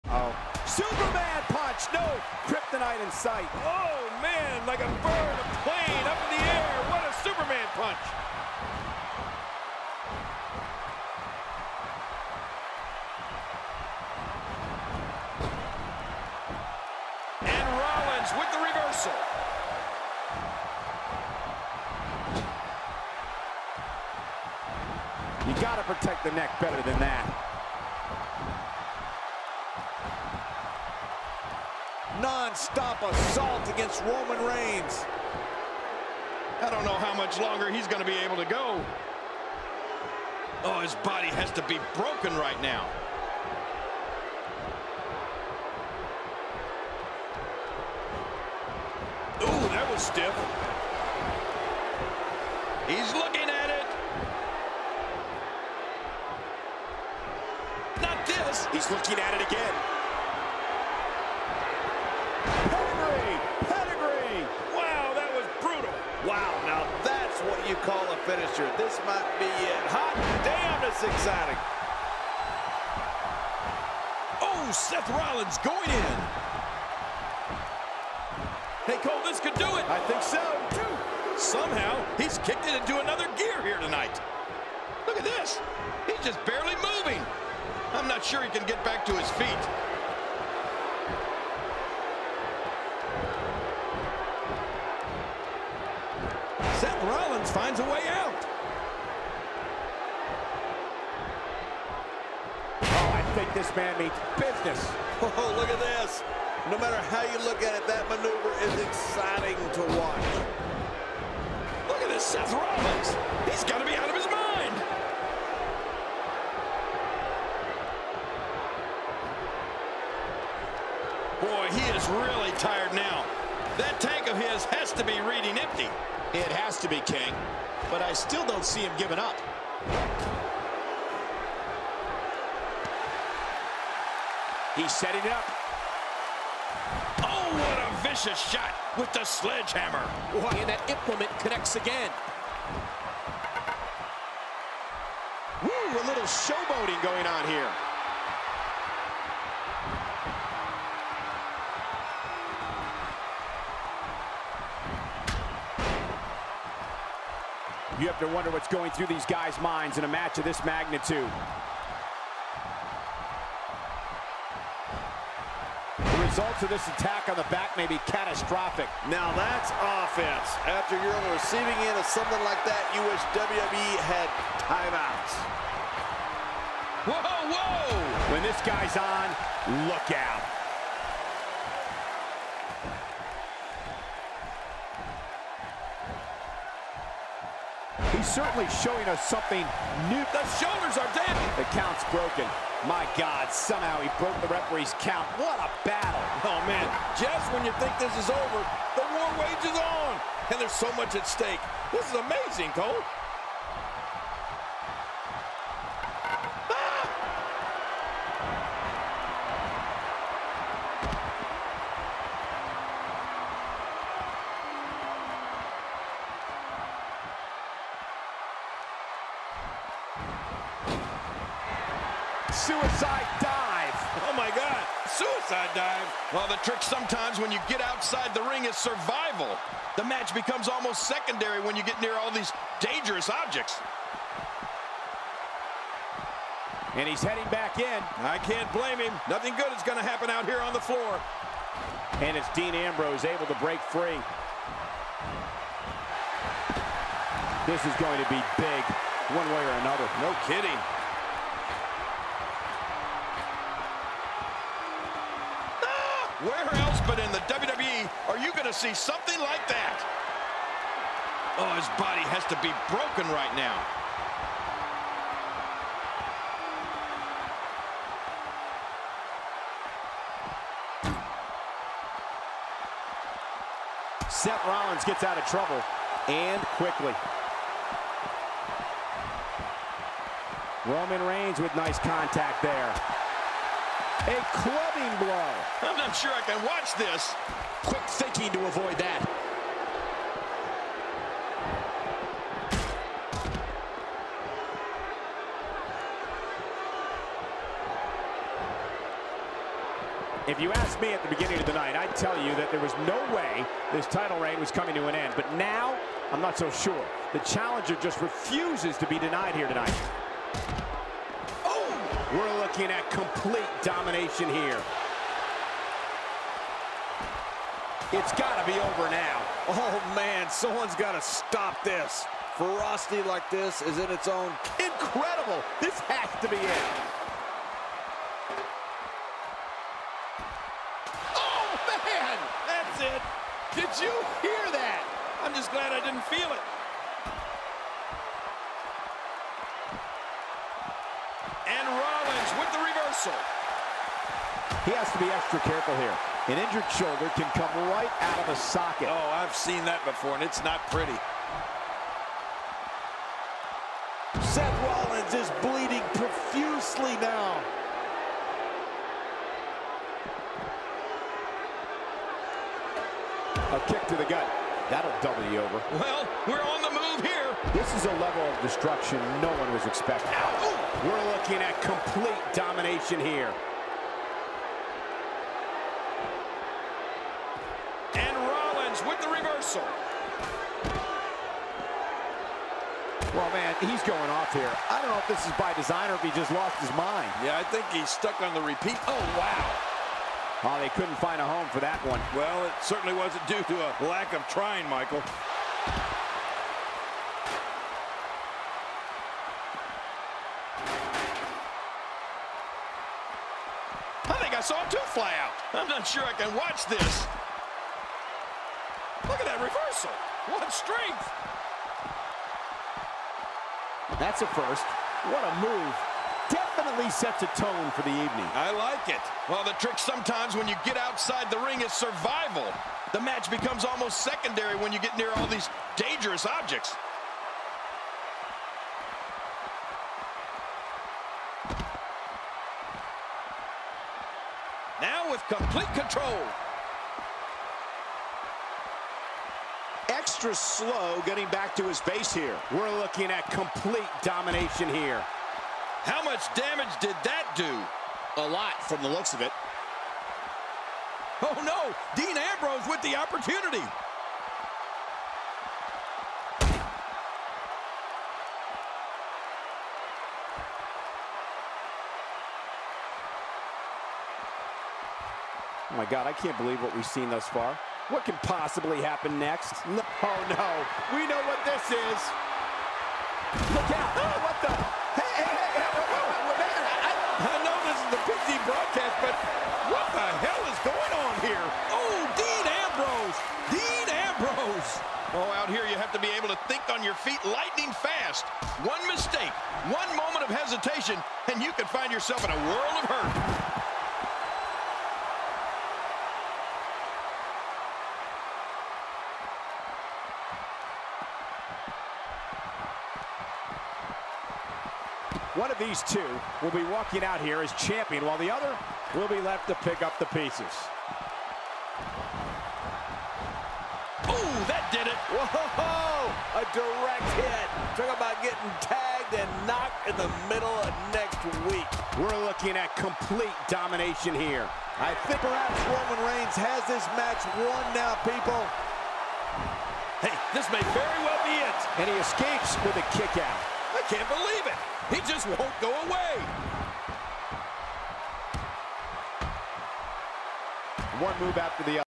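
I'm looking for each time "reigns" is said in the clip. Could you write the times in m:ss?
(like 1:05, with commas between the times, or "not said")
0:34, 4:41, 5:04, 8:46.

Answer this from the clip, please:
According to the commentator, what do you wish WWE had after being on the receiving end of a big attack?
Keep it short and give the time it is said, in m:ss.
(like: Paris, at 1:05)
Timeouts, at 2:54.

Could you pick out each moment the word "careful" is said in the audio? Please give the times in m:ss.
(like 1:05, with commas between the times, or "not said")
5:45.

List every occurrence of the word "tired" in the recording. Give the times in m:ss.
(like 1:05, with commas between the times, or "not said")
2:02.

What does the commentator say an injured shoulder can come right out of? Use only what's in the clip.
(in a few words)
A socket.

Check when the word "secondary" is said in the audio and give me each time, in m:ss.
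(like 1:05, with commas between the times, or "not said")
3:51, 7:04.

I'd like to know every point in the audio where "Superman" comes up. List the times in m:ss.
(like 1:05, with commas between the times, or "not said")
0:00, 0:07.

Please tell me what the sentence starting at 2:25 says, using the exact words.
Woo, a little showboating going on here.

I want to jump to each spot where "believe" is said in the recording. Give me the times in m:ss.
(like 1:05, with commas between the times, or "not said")
7:46, 8:54.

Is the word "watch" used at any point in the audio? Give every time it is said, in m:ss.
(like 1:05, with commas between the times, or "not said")
1:49, 4:46, 6:46.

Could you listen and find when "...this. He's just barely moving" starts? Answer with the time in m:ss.
1:25.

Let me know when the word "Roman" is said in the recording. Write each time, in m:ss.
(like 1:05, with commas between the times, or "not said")
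0:34, 4:40, 8:45.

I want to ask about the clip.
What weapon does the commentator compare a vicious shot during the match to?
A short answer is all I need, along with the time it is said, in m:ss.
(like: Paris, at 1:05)
Sledgehammer, at 2:19.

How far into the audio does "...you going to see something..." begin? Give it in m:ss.
4:18.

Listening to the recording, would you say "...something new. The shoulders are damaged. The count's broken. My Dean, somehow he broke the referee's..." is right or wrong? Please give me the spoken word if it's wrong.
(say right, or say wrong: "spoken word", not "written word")
wrong: "God", not "Dean".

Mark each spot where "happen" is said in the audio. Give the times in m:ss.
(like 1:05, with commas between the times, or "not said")
4:00, 7:49.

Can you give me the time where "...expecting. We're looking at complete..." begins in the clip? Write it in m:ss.
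6:09.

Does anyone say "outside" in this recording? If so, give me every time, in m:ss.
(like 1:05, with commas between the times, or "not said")
3:47, 7:00.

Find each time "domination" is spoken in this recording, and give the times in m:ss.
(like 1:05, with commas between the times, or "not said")
5:13, 6:12, 7:24, 8:43.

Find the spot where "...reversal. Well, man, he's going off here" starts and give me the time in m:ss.
6:19.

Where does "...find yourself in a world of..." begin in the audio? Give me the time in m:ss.
8:11.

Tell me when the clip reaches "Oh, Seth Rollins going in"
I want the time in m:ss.
1:14.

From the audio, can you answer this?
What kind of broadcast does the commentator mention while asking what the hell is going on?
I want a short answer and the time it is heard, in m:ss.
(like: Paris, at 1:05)
PG broadcast, at 7:58.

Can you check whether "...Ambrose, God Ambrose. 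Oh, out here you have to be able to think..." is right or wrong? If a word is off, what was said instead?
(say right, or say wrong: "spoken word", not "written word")
wrong: "Dean", not "God".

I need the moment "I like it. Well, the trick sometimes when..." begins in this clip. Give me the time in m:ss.
6:58.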